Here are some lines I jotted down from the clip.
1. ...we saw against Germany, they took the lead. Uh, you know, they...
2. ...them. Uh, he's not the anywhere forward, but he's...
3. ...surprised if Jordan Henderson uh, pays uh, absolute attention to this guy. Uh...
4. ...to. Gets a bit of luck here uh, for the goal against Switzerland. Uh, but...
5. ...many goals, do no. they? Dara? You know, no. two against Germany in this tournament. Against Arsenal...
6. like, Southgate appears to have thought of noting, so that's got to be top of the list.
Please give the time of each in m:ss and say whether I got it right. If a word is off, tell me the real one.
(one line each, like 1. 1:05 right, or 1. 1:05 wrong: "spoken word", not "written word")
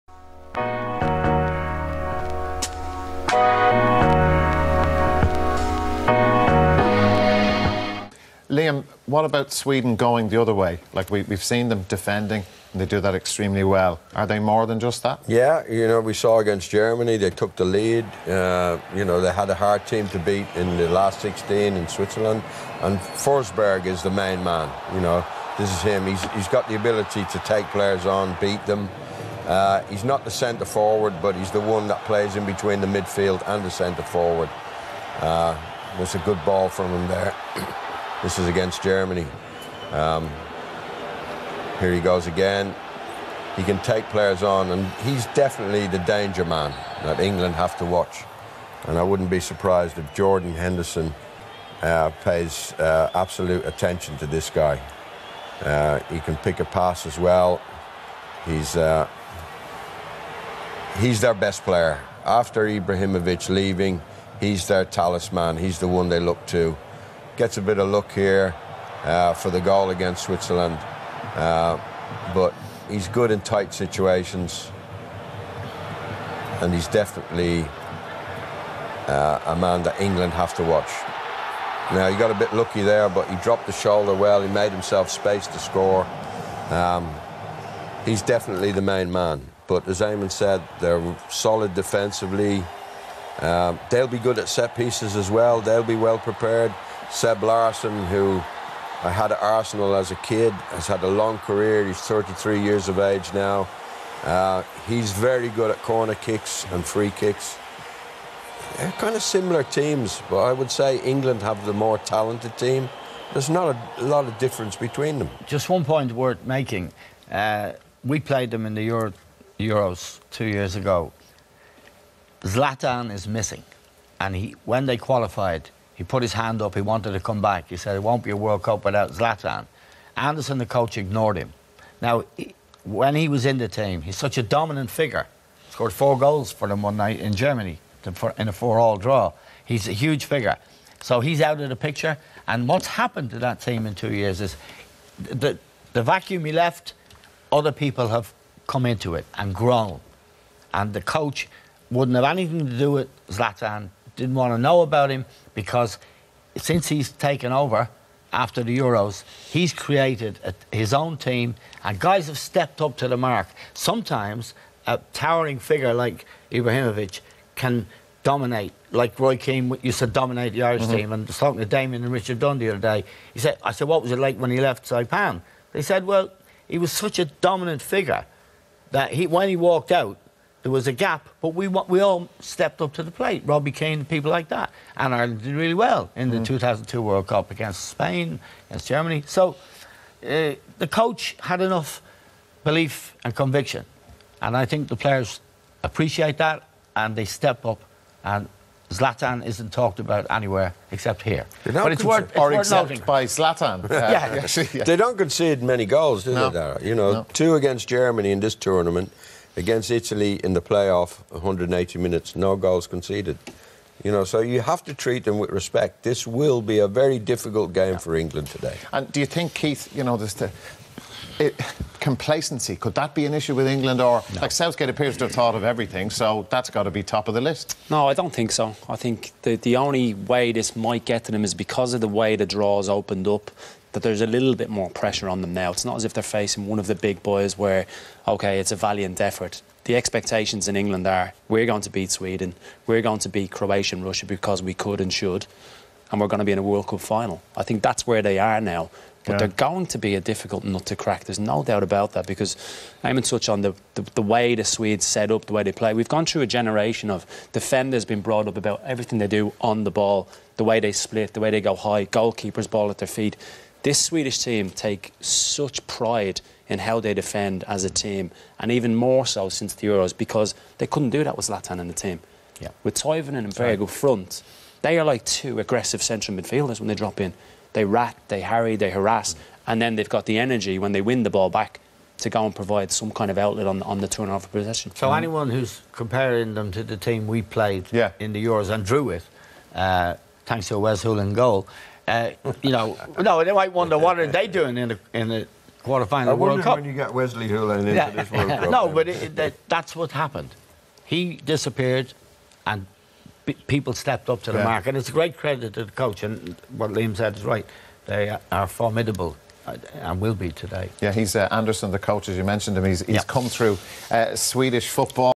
1. 0:15 right
2. 0:28 wrong: "centre", not "anywhere"
3. 0:49 right
4. 1:06 right
5. 3:25 wrong: "Italy", not "Arsenal"
6. 3:44 wrong: "everything", not "noting".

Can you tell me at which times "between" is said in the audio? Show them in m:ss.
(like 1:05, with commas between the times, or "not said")
0:32, 1:54.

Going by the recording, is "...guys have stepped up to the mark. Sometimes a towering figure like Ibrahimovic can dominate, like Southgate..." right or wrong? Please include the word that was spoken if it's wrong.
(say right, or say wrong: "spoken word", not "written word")
wrong: "Roy", not "Southgate".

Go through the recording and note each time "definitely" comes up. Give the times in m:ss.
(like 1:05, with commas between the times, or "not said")
0:45, 1:16, 1:28.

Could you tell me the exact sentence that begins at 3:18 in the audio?
And Zlatan isn't talked about anywhere except here.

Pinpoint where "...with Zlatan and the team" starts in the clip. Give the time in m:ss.
4:31.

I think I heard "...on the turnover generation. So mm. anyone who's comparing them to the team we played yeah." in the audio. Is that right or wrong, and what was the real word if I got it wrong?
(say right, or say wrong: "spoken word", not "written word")
wrong: "possession", not "generation".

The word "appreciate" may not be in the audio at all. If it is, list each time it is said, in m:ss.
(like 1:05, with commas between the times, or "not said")
3:15.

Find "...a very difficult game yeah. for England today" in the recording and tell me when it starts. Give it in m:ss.
3:36.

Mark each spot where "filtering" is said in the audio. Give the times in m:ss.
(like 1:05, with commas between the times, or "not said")
not said.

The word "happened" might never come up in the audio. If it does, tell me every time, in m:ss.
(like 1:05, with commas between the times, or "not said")
2:22, 5:00.